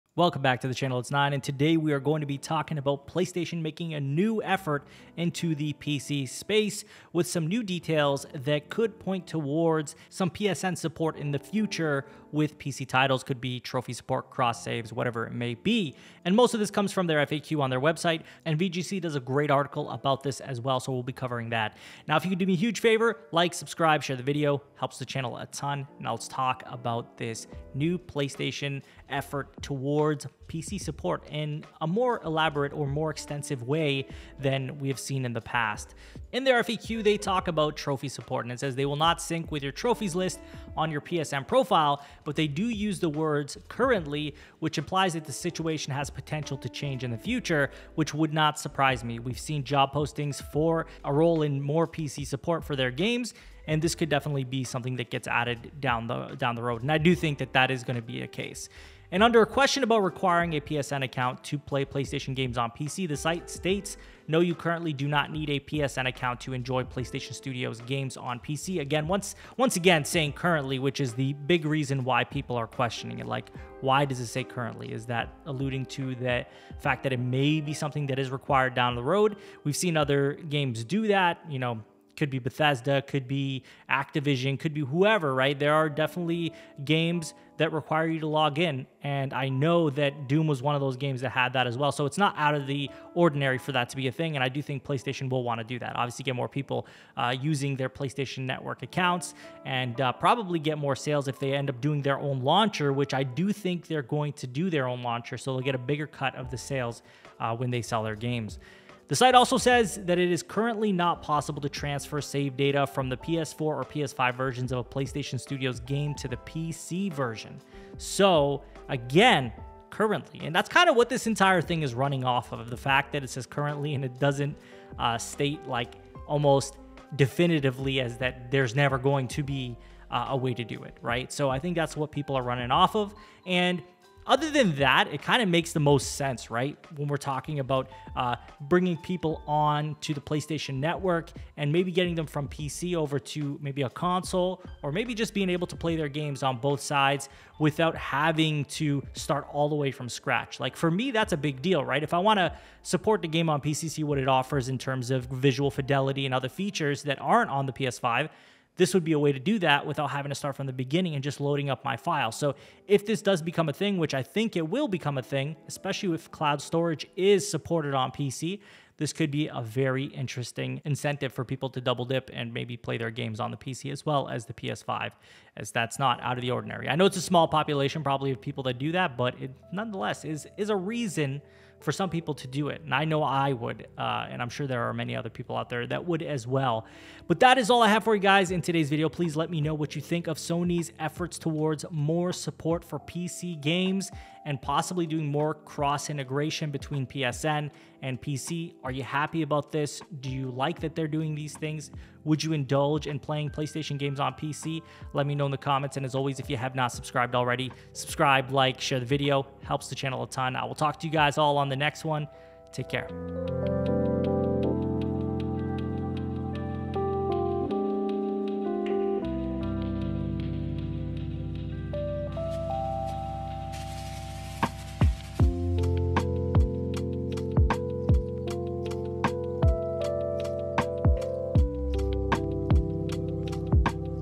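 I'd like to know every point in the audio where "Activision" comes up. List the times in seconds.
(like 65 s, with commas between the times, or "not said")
83 s.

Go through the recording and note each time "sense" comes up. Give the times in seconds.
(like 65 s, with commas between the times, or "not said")
136 s.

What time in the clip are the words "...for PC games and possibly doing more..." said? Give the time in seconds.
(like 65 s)
192 s.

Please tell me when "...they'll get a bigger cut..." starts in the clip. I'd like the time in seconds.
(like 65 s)
105 s.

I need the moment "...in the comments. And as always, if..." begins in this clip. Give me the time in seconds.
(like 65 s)
205 s.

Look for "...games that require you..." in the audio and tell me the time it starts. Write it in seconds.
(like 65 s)
86 s.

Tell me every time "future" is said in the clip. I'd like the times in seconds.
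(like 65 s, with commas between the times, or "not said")
11 s, 47 s.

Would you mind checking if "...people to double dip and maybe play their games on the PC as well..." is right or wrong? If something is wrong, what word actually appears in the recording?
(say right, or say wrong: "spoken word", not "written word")
right.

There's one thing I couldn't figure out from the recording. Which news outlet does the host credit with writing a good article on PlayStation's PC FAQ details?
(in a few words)
VGC.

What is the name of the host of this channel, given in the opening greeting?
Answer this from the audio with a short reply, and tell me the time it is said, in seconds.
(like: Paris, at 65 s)
NIXNE, at 1 s.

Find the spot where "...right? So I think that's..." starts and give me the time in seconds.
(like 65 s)
131 s.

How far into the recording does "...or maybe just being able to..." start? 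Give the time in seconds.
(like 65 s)
144 s.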